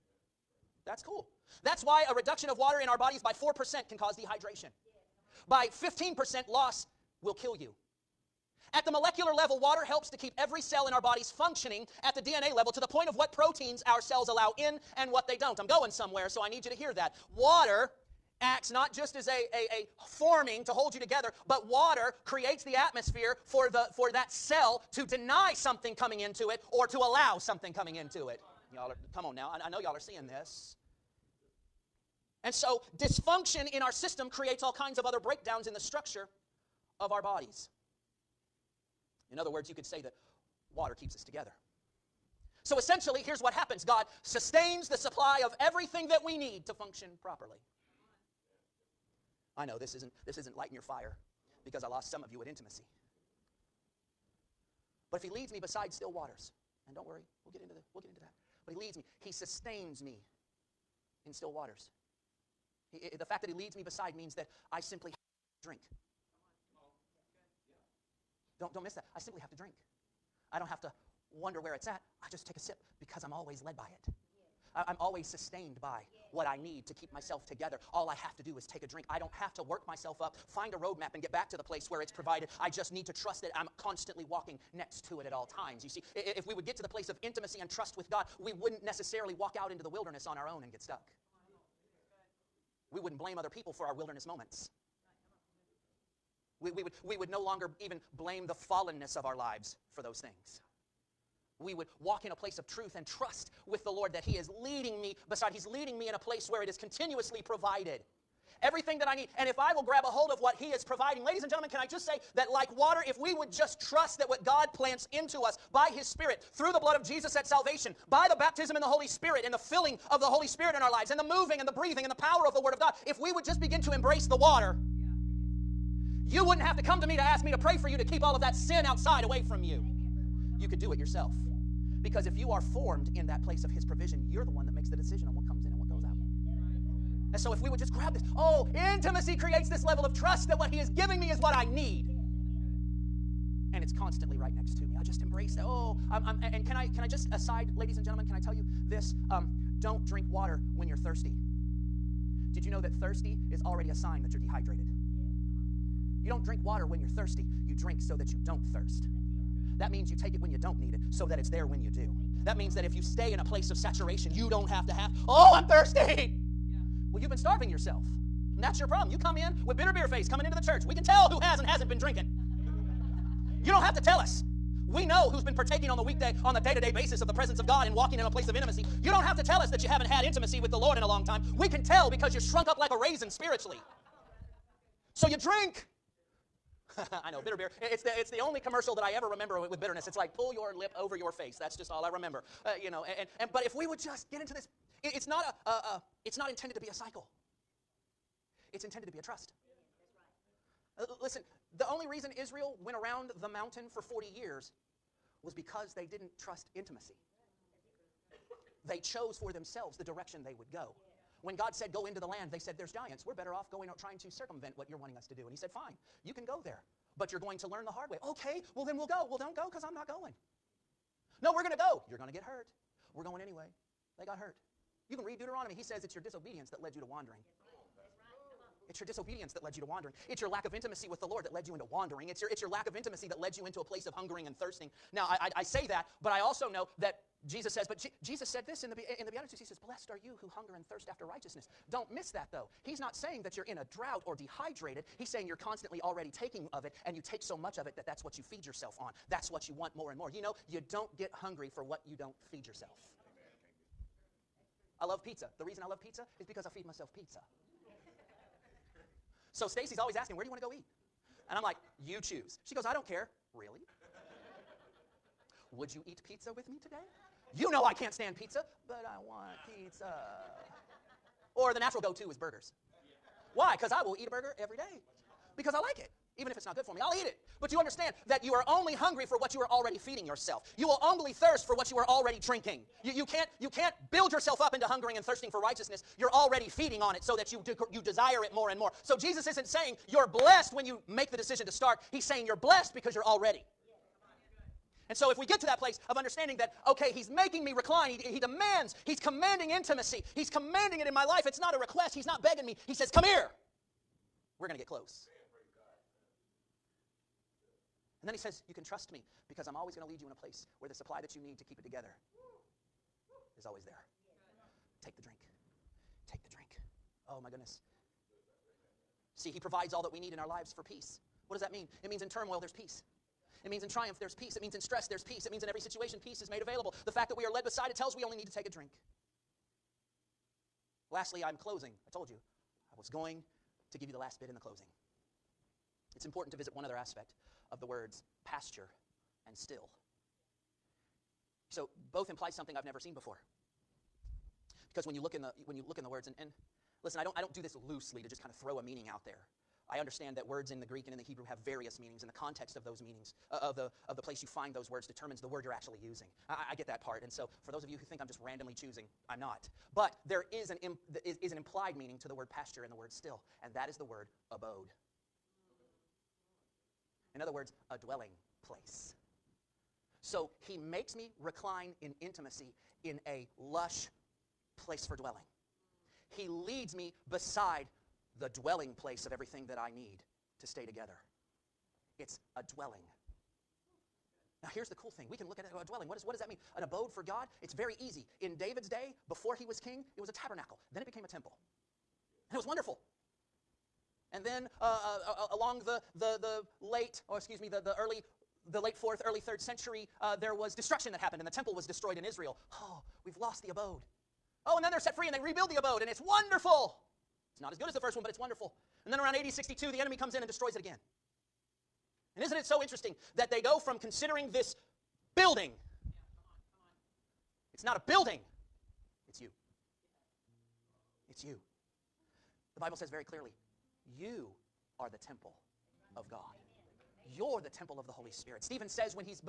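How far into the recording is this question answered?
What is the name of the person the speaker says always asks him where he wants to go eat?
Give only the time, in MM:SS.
04:19.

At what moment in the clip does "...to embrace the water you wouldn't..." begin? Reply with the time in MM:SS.
02:03.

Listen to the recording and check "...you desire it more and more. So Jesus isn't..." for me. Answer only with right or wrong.
right.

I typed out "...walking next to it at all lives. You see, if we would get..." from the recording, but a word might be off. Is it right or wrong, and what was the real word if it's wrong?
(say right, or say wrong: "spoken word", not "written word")
wrong: "times", not "lives".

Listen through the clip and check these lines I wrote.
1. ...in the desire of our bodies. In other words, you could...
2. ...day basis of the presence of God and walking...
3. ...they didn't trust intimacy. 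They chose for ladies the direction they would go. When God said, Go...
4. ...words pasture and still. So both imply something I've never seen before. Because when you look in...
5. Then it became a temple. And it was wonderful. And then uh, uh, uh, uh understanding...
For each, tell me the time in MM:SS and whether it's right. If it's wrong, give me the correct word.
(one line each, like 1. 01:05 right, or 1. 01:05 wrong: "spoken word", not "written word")
1. 00:35 wrong: "structure", not "desire"
2. 02:56 right
3. 03:25 wrong: "themselves", not "ladies"
4. 05:37 right
5. 06:30 wrong: "along", not "understanding".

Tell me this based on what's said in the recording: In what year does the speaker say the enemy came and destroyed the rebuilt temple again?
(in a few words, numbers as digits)
62.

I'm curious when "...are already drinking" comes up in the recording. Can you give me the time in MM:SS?
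04:41.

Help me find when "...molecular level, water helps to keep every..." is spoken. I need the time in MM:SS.
00:08.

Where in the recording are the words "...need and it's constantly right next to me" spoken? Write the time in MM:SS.
02:21.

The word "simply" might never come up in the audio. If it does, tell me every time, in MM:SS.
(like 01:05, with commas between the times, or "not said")
01:04, 01:09.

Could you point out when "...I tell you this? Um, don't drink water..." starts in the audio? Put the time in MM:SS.
02:28.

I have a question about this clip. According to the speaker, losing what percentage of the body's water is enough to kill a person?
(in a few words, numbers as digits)
15%.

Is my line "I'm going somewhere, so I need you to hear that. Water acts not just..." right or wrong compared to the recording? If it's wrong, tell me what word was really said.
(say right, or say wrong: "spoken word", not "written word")
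right.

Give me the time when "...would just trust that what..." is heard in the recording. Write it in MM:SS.
01:53.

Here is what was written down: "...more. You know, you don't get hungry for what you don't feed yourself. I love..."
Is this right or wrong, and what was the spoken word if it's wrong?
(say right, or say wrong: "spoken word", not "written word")
right.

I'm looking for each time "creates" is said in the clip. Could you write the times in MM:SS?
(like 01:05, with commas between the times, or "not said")
00:22, 00:34, 02:19.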